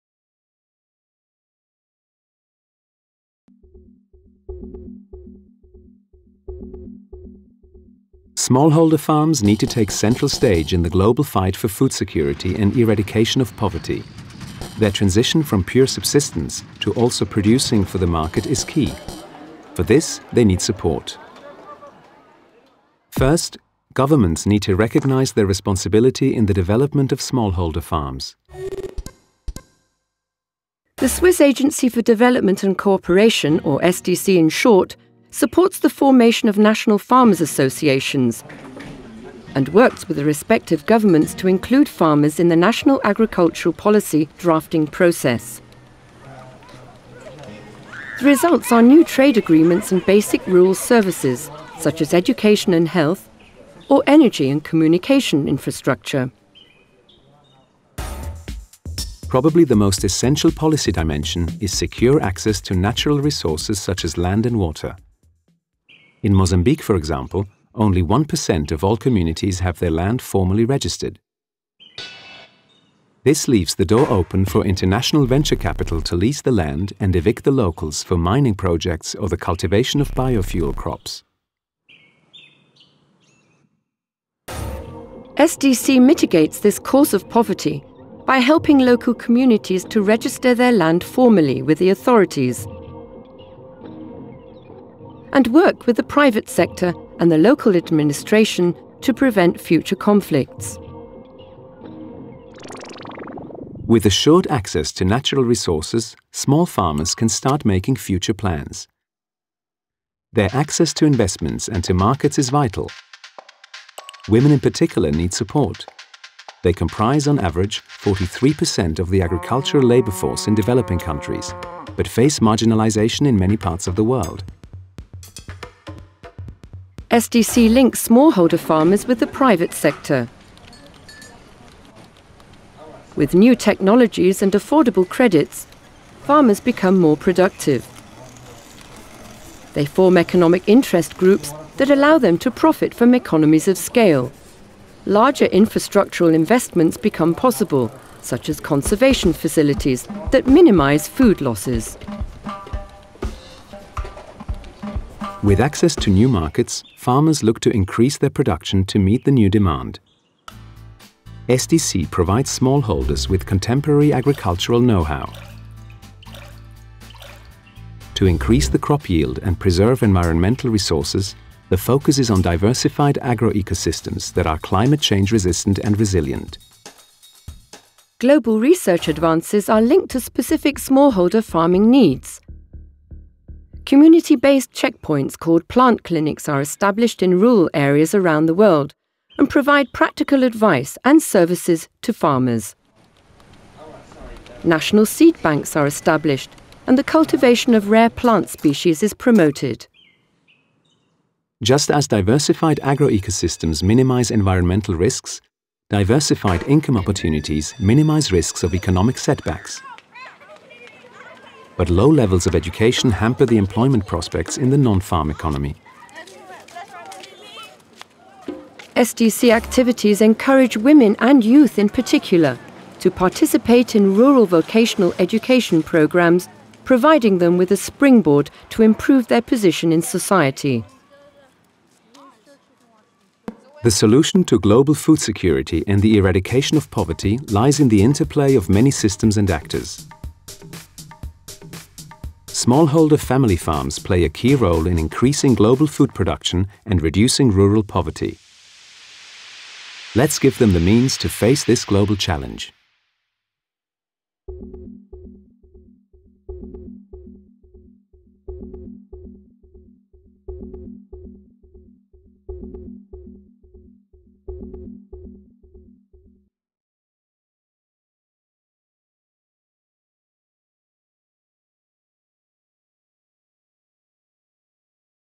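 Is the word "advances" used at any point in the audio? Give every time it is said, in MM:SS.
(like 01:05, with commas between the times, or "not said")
02:59.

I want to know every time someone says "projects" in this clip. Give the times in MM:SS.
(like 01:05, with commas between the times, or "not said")
01:18.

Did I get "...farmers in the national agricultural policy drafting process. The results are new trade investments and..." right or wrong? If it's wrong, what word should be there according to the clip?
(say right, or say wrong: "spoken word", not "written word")
wrong: "agreements", not "investments".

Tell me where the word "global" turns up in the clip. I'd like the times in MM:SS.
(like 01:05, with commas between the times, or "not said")
00:10, 02:58, 03:54, 04:05, 04:11.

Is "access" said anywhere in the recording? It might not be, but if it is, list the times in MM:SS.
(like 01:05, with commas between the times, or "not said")
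01:02, 01:44, 01:50, 02:35.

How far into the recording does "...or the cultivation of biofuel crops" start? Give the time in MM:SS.
01:19.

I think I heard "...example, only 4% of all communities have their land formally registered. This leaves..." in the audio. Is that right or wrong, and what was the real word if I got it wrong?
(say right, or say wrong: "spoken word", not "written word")
wrong: "1", not "4".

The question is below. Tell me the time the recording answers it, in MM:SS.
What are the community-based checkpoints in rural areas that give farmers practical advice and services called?
03:05.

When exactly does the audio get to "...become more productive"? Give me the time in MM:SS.
02:16.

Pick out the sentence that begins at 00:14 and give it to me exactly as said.
Their transition from pure subsistence to also producing for the market is key.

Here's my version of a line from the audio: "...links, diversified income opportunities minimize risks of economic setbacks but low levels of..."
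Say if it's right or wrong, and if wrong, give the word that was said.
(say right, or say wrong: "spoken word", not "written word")
wrong: "risks", not "links".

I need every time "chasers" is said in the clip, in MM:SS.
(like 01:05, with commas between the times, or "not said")
not said.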